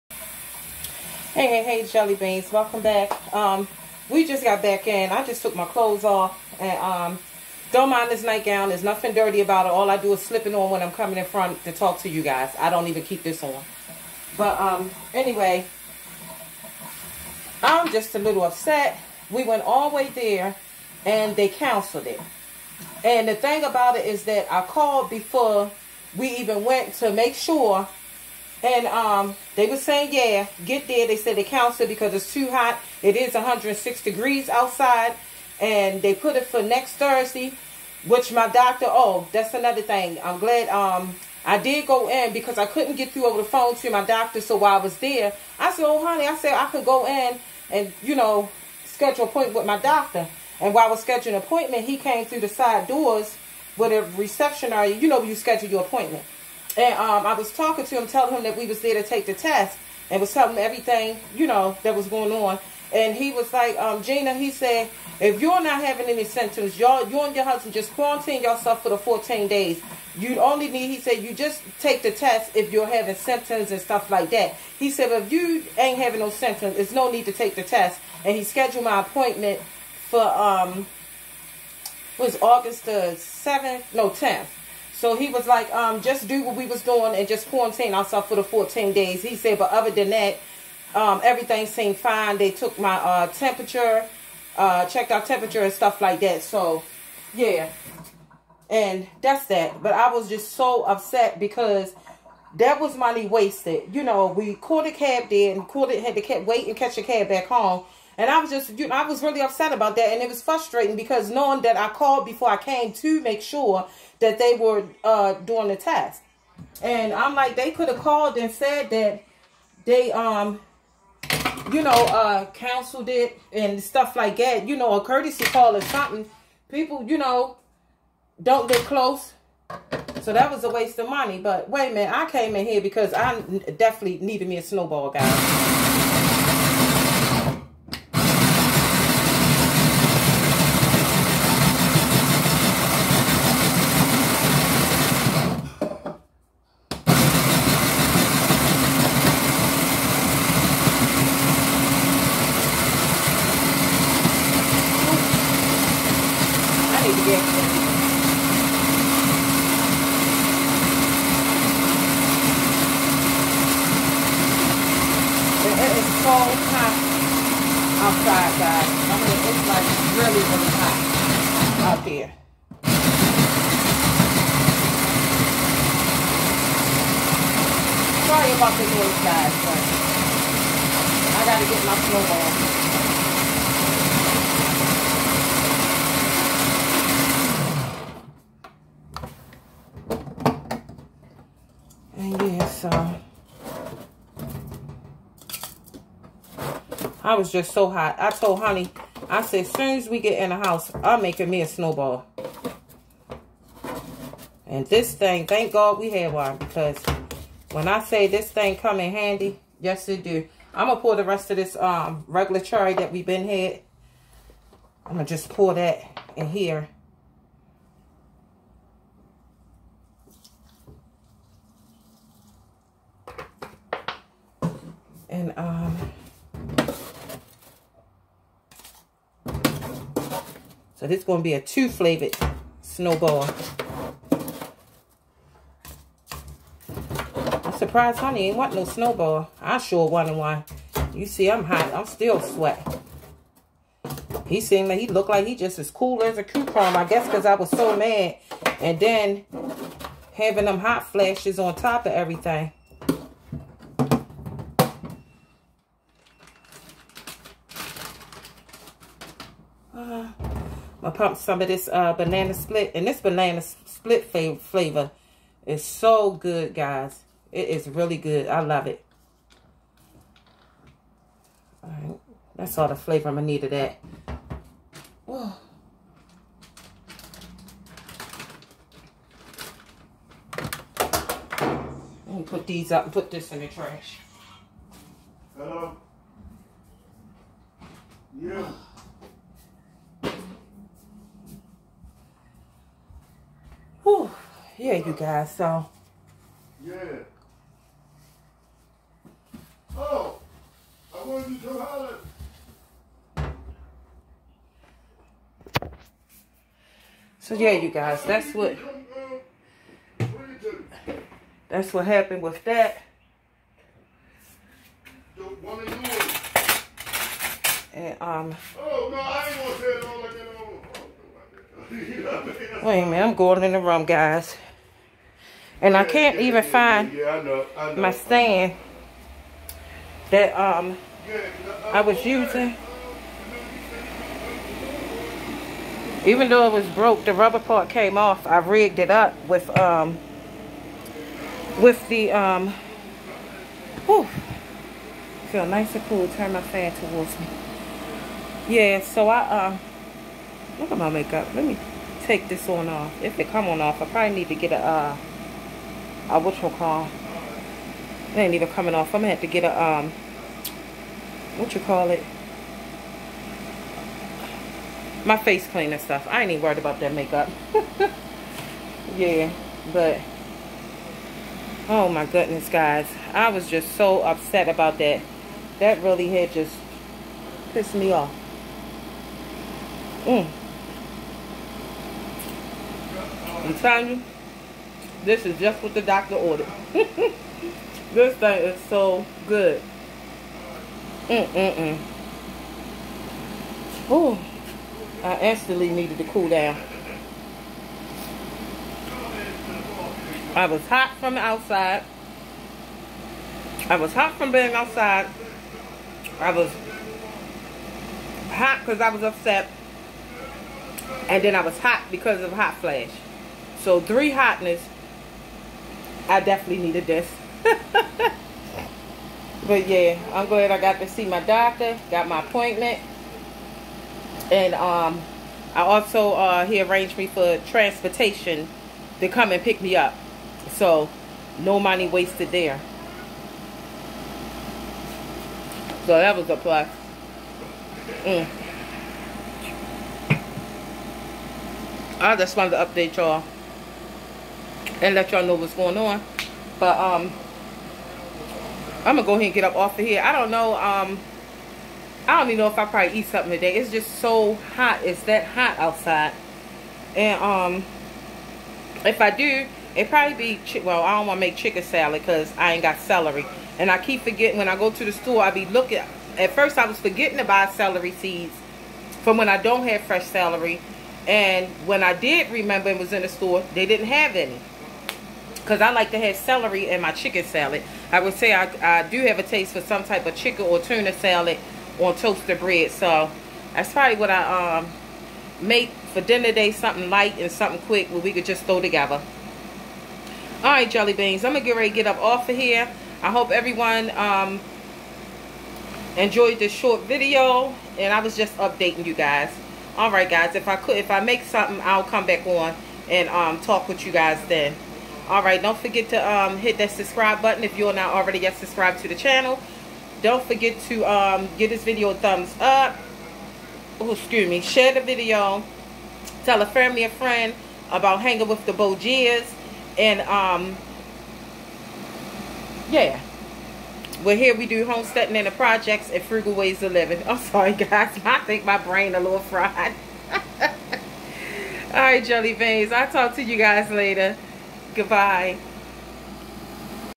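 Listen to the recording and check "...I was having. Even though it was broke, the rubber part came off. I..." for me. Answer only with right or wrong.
wrong.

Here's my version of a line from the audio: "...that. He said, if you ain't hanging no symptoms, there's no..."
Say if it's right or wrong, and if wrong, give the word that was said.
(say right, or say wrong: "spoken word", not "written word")
wrong: "having", not "hanging".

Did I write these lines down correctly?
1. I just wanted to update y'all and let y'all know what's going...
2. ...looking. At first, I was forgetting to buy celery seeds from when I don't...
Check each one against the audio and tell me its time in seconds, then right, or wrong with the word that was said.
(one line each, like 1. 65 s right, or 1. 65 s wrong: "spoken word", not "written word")
1. 442 s right
2. 465 s right.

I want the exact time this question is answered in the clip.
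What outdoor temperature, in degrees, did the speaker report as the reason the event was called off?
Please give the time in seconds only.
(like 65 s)
33 s.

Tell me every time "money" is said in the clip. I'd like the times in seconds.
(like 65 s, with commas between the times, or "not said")
102 s, 131 s, 431 s.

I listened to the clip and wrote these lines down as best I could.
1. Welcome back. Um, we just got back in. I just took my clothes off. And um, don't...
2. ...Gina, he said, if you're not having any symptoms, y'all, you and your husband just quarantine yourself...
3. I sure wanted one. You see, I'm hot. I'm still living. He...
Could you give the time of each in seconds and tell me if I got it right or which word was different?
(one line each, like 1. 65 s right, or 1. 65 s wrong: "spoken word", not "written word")
1. 2 s right
2. 64 s right
3. 239 s wrong: "sweating", not "living".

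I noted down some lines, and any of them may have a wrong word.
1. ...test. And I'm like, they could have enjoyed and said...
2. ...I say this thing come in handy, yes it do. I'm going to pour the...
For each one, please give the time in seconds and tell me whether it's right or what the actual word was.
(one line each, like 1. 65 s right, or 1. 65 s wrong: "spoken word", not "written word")
1. 115 s wrong: "called", not "enjoyed"
2. 207 s right.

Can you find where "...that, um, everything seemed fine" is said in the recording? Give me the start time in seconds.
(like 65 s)
90 s.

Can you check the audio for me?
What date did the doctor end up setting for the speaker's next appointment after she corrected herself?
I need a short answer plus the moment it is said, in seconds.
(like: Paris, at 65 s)
August 10, at 84 s.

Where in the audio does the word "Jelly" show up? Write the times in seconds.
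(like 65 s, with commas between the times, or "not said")
1 s, 490 s, 532 s.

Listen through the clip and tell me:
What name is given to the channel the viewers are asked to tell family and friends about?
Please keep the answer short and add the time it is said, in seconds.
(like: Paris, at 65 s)
Hanging with the Bogiers, at 518 s.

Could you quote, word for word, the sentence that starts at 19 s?
We went all the way there, and they canceled it.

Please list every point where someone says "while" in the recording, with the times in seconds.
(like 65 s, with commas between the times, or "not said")
44 s, 50 s.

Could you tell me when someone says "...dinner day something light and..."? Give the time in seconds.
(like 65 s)
486 s.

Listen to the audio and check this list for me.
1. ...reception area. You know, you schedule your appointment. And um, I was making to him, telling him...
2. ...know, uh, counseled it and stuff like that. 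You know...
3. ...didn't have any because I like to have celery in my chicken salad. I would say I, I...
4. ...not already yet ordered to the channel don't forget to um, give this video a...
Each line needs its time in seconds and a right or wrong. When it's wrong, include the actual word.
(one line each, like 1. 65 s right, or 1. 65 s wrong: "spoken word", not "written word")
1. 54 s wrong: "talking", not "making"
2. 121 s right
3. 473 s right
4. 507 s wrong: "subscribed", not "ordered".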